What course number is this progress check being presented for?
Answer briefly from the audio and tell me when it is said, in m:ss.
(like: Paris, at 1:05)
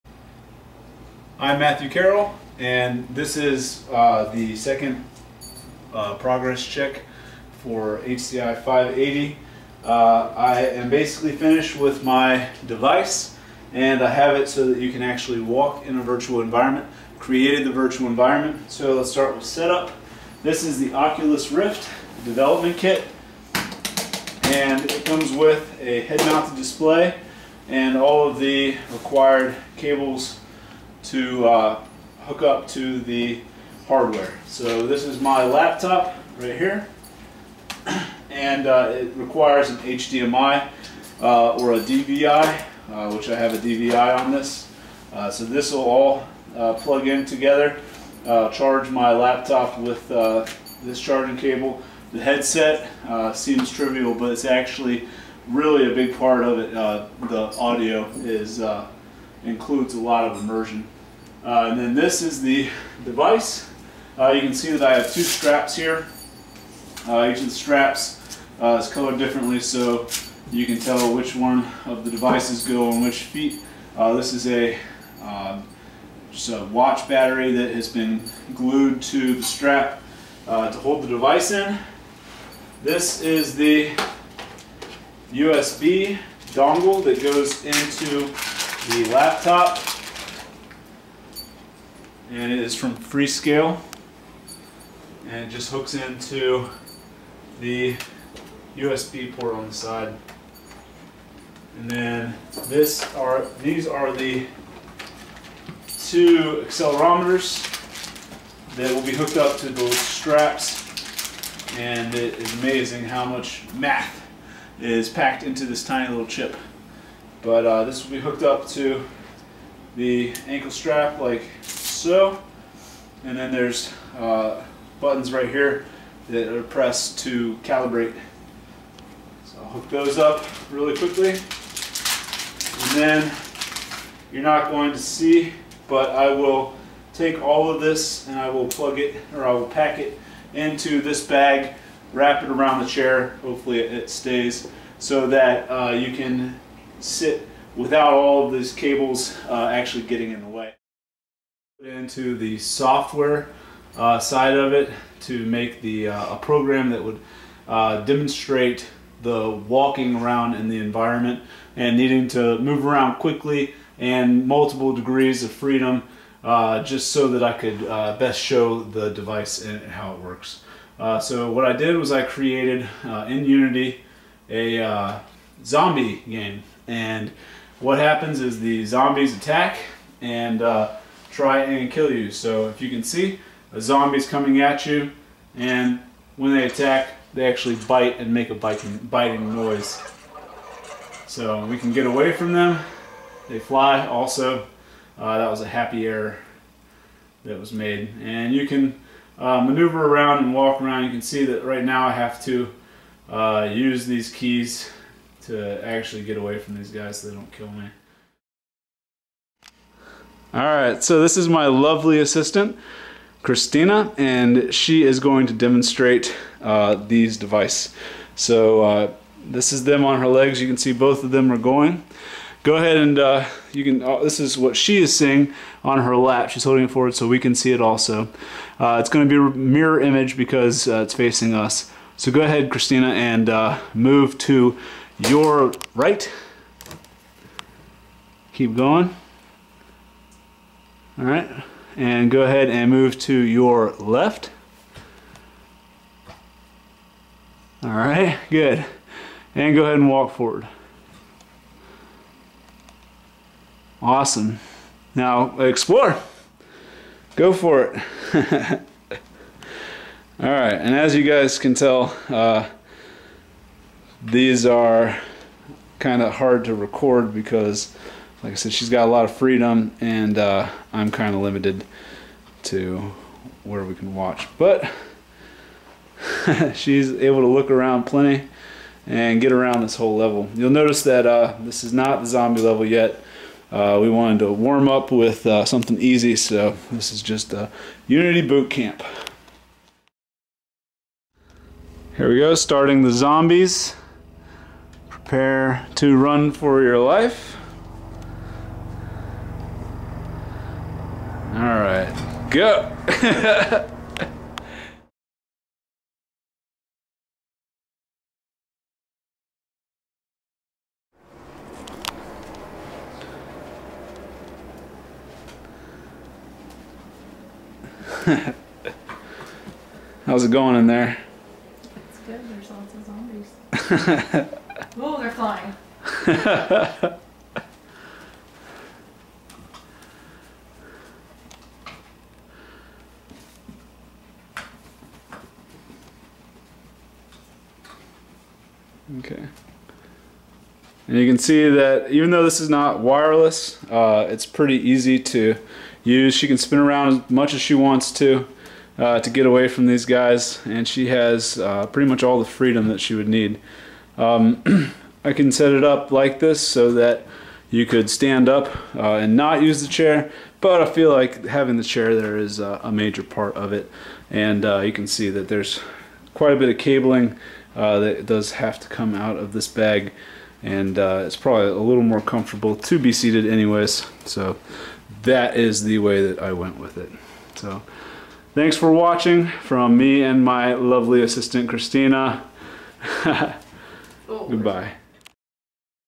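HCI 580, at 0:08.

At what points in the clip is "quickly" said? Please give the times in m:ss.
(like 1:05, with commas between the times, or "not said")
2:10, 2:43.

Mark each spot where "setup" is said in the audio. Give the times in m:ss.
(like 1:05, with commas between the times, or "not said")
0:19.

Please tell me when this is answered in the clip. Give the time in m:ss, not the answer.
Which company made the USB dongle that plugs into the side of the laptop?
1:32.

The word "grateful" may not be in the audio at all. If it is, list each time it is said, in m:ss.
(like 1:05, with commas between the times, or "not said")
not said.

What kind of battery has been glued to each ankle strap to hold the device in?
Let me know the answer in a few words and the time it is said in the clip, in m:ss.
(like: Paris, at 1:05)
watch battery, at 1:16.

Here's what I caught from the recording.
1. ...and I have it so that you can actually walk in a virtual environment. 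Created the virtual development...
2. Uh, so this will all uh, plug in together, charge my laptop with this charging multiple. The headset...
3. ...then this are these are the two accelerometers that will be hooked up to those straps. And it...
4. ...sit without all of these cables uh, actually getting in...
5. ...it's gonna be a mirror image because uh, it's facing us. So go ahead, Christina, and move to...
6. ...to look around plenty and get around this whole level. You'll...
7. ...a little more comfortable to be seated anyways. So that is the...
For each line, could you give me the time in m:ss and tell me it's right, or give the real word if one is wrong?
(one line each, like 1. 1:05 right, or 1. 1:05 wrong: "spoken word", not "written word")
1. 0:13 wrong: "environment", not "development"
2. 0:45 wrong: "cable", not "multiple"
3. 1:41 right
4. 2:27 right
5. 3:48 right
6. 4:37 right
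7. 6:11 right.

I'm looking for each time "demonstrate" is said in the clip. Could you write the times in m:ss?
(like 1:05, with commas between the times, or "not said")
2:38, 3:35.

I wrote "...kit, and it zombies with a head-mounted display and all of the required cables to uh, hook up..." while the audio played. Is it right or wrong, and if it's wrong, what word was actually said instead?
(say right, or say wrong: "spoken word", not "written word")
wrong: "comes", not "zombies".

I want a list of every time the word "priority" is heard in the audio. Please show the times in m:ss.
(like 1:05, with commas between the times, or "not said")
not said.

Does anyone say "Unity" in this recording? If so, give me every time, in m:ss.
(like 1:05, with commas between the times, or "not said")
2:53, 4:48.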